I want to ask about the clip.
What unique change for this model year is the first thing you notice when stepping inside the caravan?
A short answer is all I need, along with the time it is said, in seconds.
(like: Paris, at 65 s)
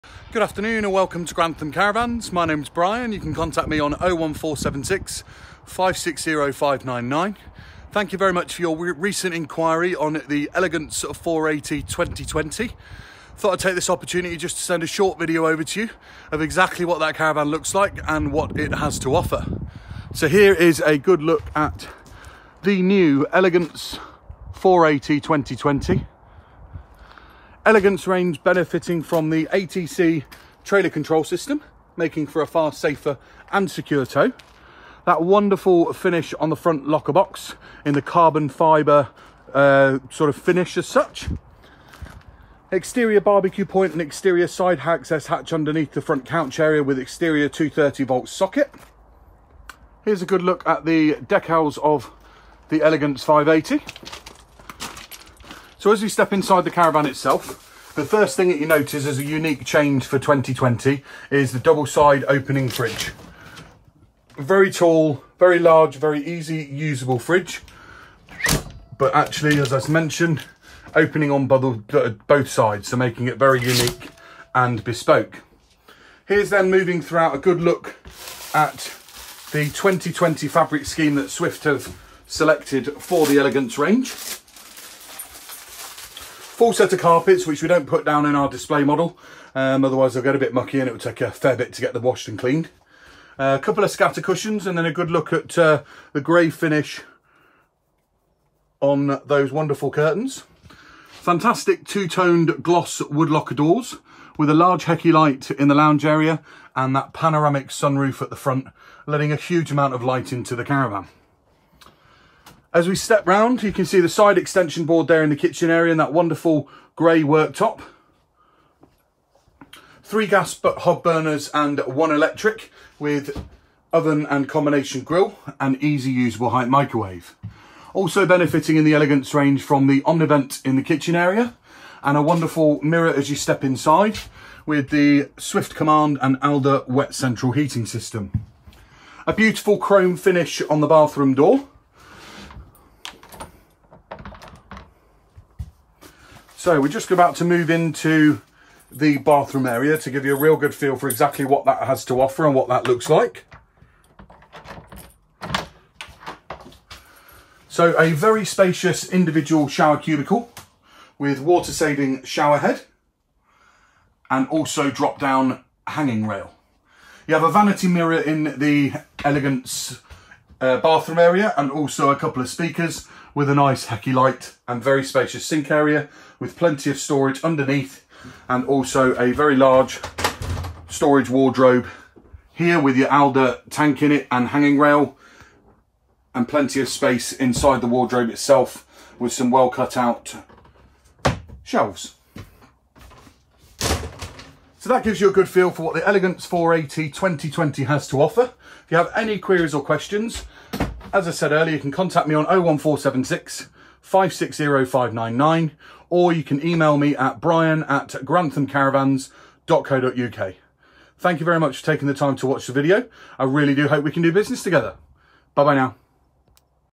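Double side opening fridge, at 61 s.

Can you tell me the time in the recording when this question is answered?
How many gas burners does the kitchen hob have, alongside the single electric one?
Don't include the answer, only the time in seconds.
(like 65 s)
120 s.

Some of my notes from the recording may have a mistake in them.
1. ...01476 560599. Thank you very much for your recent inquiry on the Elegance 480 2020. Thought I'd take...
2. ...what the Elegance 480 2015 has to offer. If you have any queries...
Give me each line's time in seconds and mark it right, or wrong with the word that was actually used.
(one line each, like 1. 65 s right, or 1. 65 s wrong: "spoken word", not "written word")
1. 3 s right
2. 195 s wrong: "2020", not "2015".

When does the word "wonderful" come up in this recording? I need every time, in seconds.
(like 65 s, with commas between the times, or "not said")
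35 s, 99 s, 116 s, 132 s.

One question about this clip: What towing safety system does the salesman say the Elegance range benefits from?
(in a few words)
ATC trailer control system.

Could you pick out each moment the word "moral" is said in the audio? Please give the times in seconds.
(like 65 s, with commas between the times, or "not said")
not said.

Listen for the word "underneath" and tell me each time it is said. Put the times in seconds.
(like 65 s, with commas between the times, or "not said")
45 s, 177 s.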